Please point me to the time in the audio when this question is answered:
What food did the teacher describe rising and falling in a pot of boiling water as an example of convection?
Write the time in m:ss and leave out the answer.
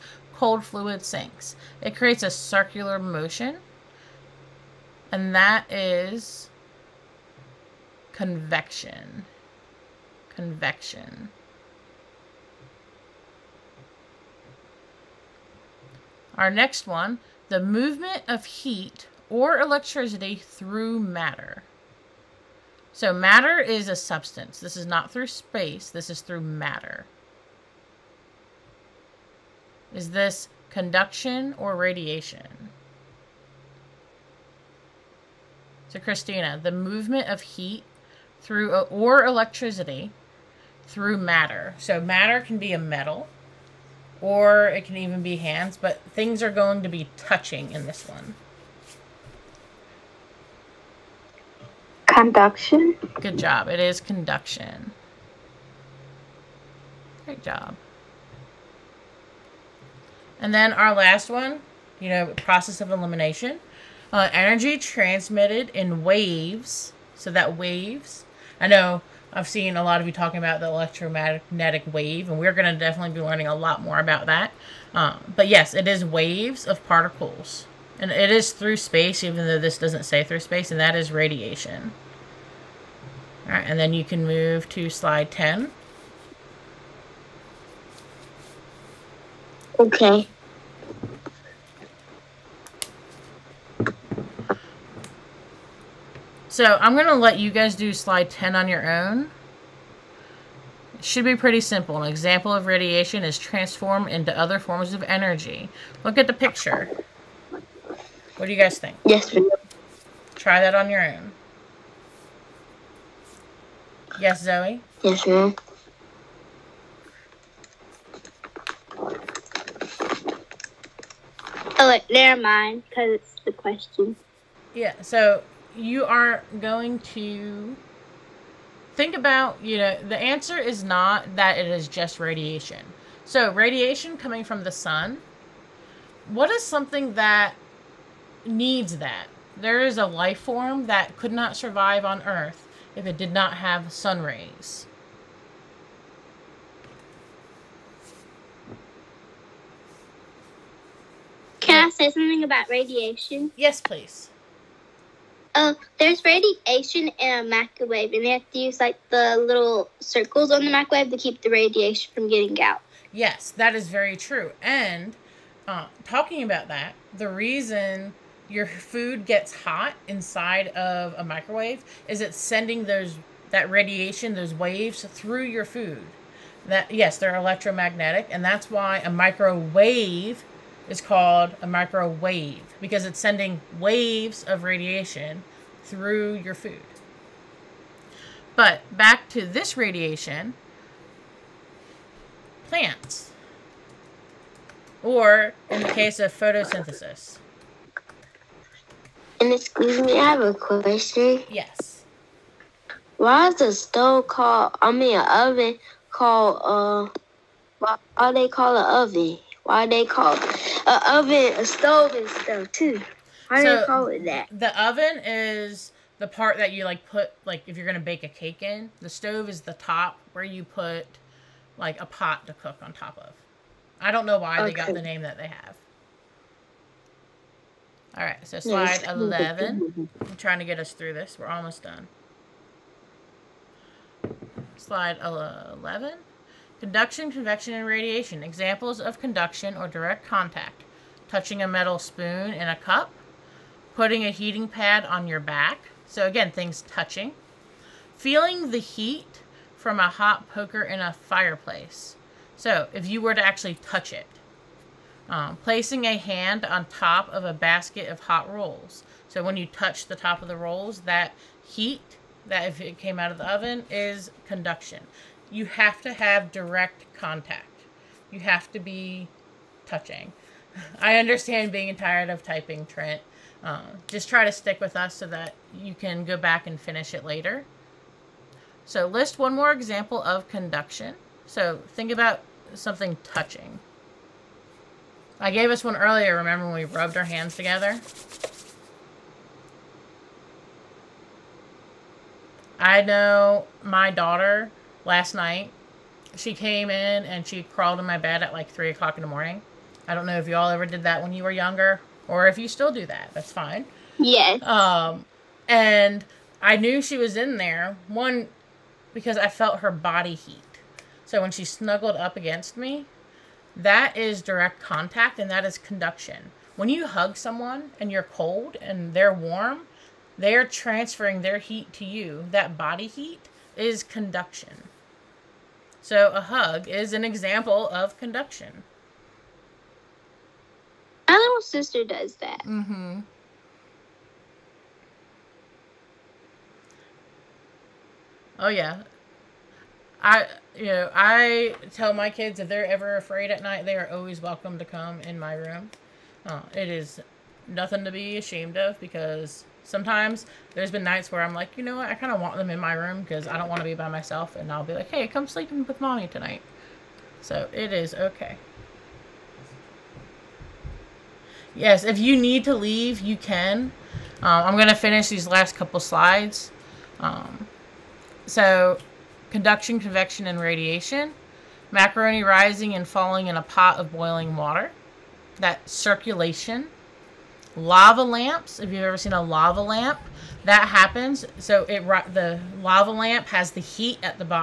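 6:11.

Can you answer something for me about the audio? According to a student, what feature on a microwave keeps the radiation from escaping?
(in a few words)
little circles.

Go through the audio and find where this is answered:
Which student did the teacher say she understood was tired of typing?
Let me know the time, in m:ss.
4:32.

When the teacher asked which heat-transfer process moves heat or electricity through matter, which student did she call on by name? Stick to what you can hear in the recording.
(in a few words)
Christina.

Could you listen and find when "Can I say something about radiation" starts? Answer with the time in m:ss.
2:31.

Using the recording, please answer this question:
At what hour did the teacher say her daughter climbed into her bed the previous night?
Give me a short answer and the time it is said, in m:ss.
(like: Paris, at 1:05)
3 o'clock, at 4:58.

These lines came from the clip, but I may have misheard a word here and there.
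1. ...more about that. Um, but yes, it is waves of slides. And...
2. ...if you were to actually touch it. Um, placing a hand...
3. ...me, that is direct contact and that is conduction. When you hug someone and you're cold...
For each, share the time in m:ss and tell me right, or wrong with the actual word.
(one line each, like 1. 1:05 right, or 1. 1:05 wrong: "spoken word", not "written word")
1. 1:13 wrong: "particles", not "slides"
2. 4:12 right
3. 5:12 right.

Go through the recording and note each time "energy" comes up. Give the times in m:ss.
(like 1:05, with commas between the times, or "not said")
1:04, 1:45.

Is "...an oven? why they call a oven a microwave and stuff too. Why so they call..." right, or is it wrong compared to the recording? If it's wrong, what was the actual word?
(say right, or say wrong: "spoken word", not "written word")
wrong: "stove", not "microwave".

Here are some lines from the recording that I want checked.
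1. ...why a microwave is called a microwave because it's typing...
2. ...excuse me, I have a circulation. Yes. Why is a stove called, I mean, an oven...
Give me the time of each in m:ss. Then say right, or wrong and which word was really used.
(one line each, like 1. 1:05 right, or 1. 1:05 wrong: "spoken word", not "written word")
1. 2:58 wrong: "sending", not "typing"
2. 3:19 wrong: "question", not "circulation".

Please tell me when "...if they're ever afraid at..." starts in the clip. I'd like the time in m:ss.
5:42.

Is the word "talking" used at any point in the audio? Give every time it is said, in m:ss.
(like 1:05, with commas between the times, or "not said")
1:10, 2:46.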